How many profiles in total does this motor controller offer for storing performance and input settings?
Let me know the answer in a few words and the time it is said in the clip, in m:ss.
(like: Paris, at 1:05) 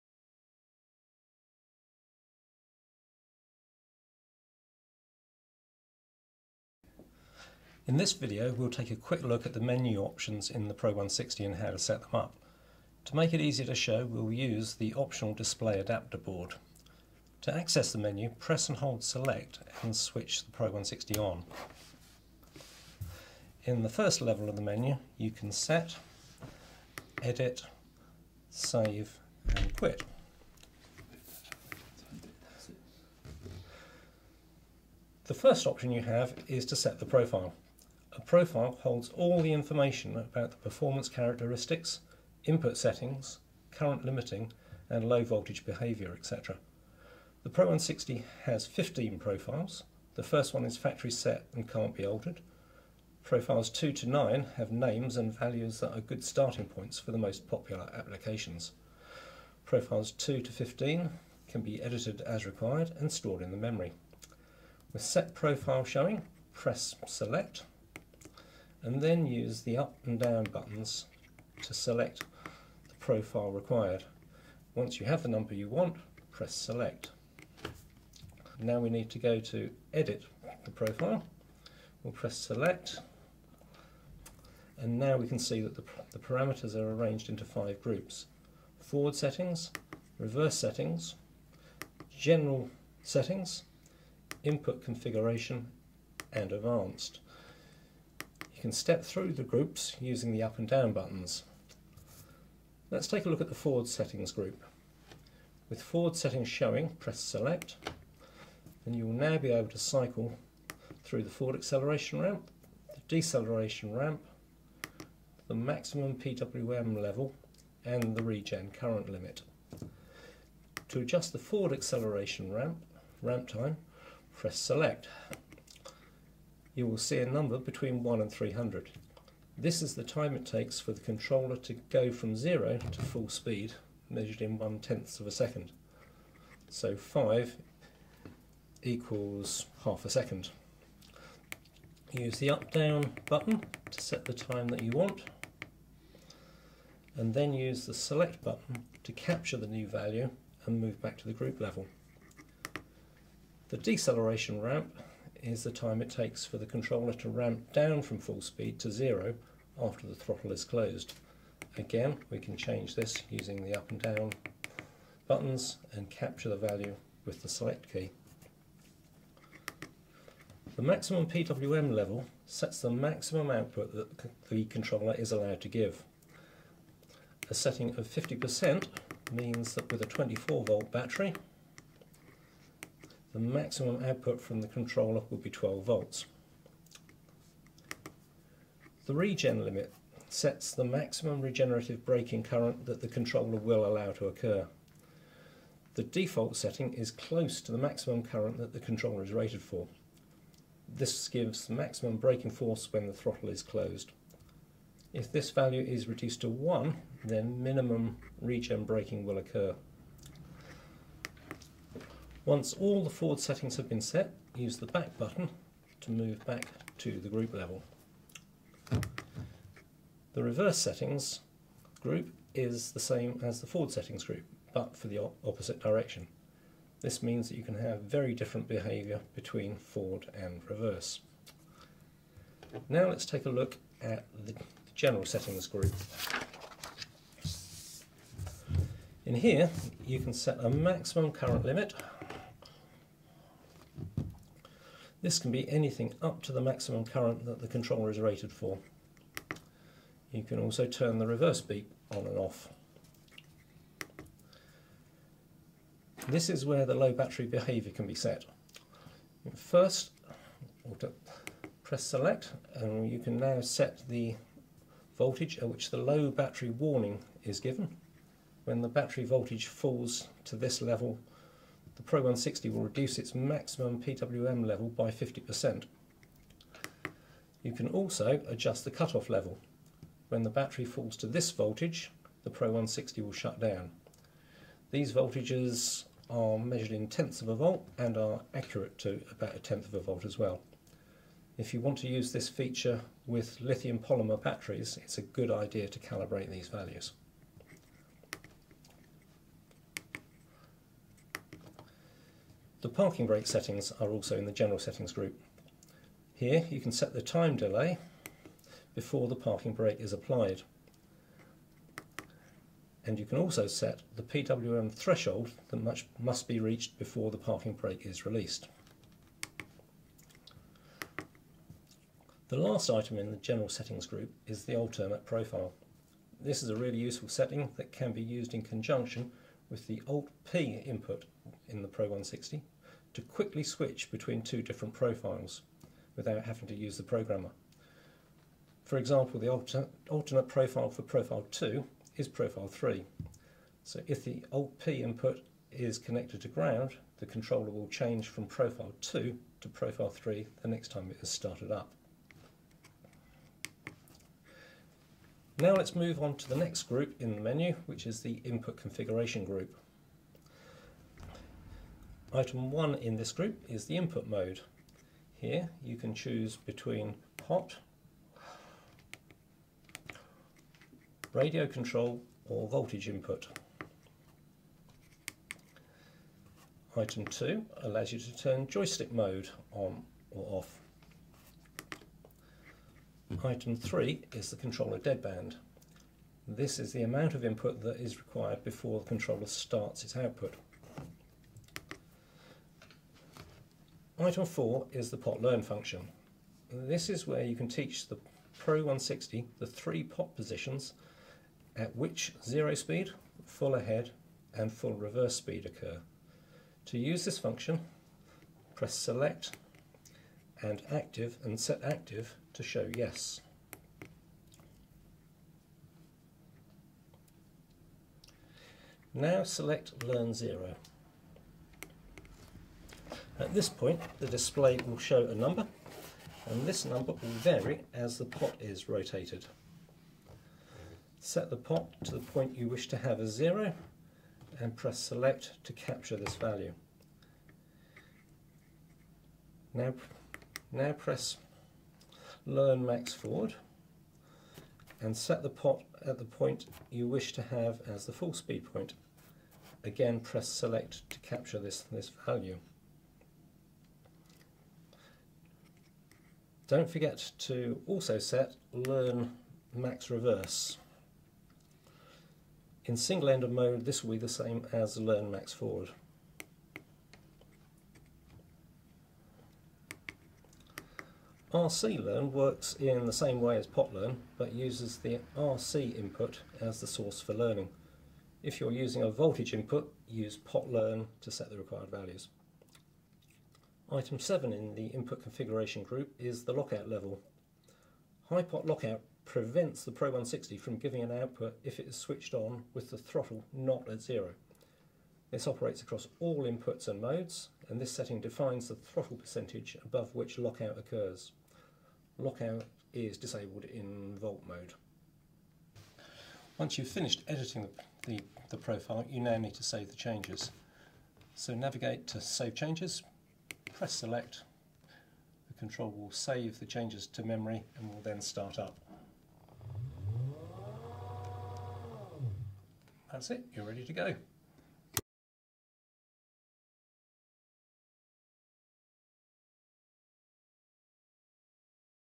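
15, at 0:48.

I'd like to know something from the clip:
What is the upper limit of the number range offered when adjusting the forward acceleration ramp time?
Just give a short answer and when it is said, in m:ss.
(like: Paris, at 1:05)
300, at 2:08.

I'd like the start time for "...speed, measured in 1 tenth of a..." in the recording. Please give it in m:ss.
2:13.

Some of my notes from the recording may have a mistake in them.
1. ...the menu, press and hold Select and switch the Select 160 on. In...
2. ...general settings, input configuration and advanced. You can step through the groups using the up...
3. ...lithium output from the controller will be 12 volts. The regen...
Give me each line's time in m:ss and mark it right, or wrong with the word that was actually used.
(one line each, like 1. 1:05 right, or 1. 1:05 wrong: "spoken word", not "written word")
1. 0:17 wrong: "Pro", not "Select"
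2. 1:32 right
3. 3:03 wrong: "maximum", not "lithium".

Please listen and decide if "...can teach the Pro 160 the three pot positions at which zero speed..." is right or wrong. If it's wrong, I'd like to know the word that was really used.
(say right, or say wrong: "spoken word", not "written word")
right.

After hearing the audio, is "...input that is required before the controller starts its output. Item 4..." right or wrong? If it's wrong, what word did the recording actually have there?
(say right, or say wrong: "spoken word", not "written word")
right.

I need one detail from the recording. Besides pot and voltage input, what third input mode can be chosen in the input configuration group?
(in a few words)
radio control.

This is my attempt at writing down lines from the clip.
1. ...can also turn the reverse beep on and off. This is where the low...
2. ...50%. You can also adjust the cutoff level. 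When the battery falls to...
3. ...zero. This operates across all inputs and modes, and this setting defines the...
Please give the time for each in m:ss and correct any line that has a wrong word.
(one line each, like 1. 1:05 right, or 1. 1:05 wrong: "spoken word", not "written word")
1. 4:10 right
2. 4:35 right
3. 8:14 right.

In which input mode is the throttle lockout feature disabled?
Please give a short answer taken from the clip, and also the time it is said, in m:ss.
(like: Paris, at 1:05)
Volt mode, at 8:24.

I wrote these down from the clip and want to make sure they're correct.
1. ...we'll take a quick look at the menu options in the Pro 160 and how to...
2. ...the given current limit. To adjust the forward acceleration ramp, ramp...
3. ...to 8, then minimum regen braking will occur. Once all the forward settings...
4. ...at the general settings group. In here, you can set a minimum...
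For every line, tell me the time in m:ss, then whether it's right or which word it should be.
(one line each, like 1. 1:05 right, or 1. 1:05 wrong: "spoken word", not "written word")
1. 0:08 right
2. 1:58 wrong: "regen", not "given"
3. 3:26 wrong: "1", not "8"
4. 3:54 wrong: "maximum", not "minimum".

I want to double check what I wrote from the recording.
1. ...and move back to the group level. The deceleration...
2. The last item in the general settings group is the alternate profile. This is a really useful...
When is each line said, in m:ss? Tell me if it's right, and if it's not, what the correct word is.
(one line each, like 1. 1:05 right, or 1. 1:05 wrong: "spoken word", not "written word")
1. 2:30 right
2. 5:22 right.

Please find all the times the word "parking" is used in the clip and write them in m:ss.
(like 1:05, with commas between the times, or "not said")
5:02, 5:09, 5:17.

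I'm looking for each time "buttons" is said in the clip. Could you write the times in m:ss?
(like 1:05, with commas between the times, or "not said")
1:10, 1:40, 2:23, 2:28, 2:45, 3:35.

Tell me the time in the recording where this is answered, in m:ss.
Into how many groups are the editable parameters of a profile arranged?
1:27.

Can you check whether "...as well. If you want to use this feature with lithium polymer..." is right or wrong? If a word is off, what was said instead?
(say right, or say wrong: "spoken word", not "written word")
right.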